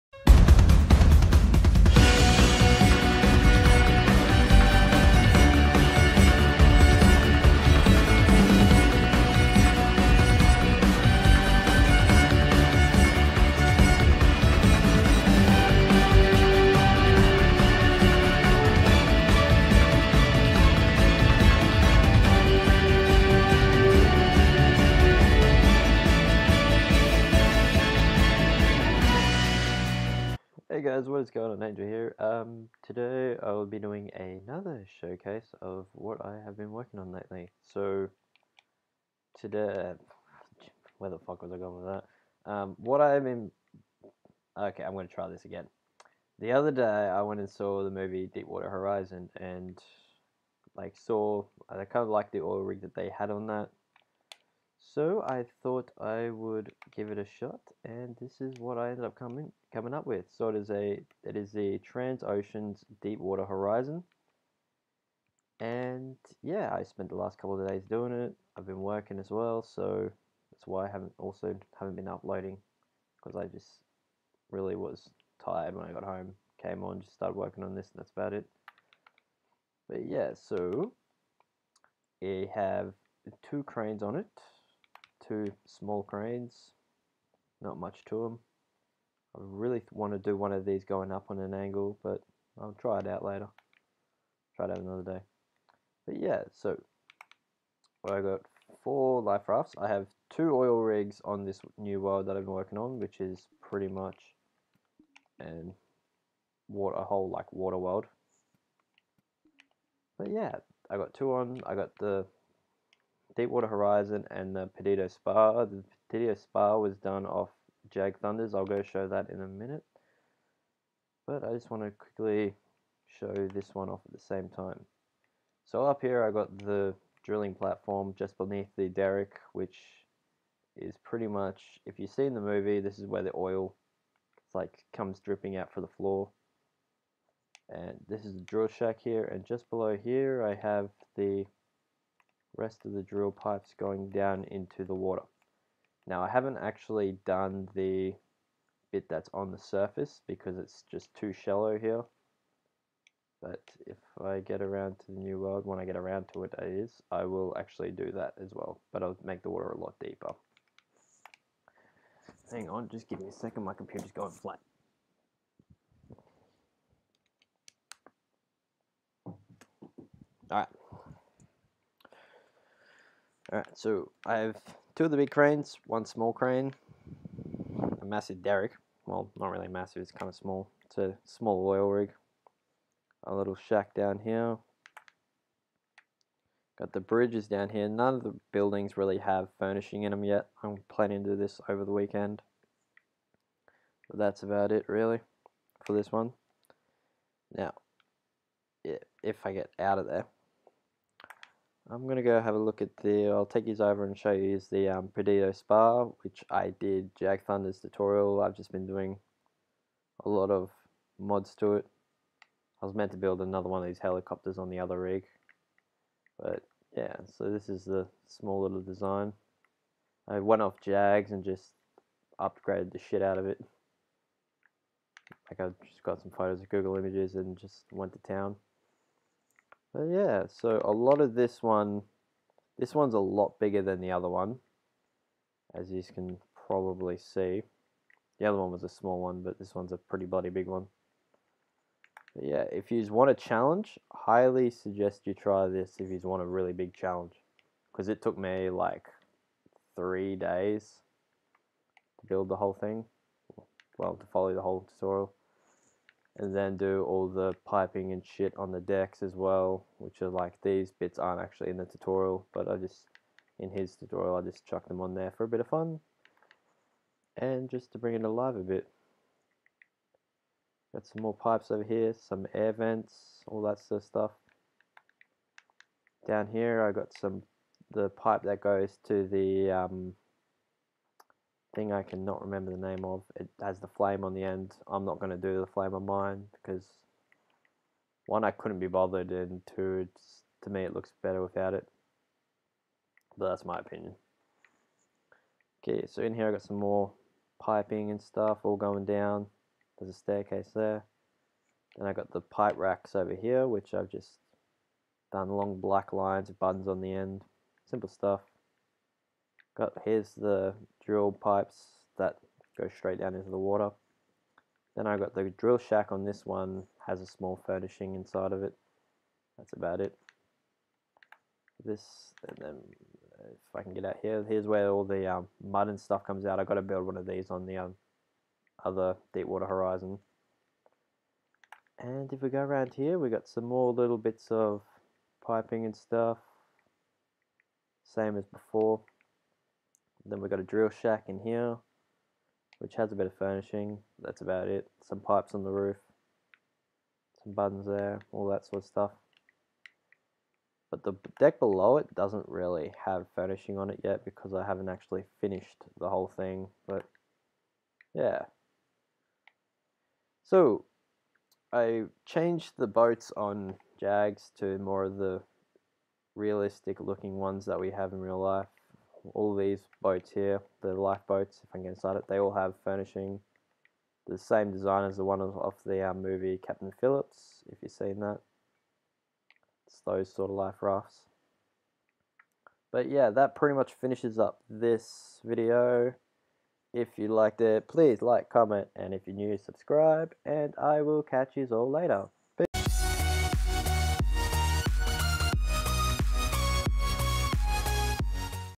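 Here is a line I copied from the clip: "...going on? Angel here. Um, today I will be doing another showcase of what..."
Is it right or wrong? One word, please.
right.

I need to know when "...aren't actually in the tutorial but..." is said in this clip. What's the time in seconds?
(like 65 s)
261 s.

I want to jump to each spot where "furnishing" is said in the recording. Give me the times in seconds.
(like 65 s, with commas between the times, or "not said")
189 s, 317 s, 343 s, 353 s, 372 s.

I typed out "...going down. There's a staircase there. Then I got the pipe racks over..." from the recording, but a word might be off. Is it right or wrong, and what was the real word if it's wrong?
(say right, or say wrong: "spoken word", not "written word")
right.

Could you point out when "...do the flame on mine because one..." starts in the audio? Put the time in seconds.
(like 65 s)
285 s.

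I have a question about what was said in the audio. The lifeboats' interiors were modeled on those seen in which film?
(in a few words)
Captain Phillips.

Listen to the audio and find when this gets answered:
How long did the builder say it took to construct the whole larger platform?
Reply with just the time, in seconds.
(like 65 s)
249 s.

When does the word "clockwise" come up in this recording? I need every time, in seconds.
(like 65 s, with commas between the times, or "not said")
not said.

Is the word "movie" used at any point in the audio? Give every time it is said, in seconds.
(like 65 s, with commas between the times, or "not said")
47 s, 132 s, 376 s.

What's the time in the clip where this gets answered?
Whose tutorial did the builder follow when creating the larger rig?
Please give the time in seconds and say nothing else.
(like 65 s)
117 s.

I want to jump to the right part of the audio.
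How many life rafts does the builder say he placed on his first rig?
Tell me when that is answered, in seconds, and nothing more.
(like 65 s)
98 s.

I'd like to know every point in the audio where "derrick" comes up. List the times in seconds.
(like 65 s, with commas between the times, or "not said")
128 s, 178 s.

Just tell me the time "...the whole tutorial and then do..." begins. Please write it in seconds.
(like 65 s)
254 s.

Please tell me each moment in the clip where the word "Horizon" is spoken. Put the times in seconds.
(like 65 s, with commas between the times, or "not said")
48 s, 63 s, 113 s, 329 s.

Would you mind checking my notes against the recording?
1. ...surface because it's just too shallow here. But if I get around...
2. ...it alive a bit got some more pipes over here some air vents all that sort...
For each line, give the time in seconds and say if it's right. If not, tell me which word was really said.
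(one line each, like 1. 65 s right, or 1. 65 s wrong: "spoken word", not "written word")
1. 149 s right
2. 268 s right.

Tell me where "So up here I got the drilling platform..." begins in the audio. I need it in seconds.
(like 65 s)
125 s.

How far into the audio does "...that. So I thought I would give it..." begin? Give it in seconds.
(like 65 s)
53 s.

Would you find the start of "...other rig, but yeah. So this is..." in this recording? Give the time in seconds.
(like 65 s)
214 s.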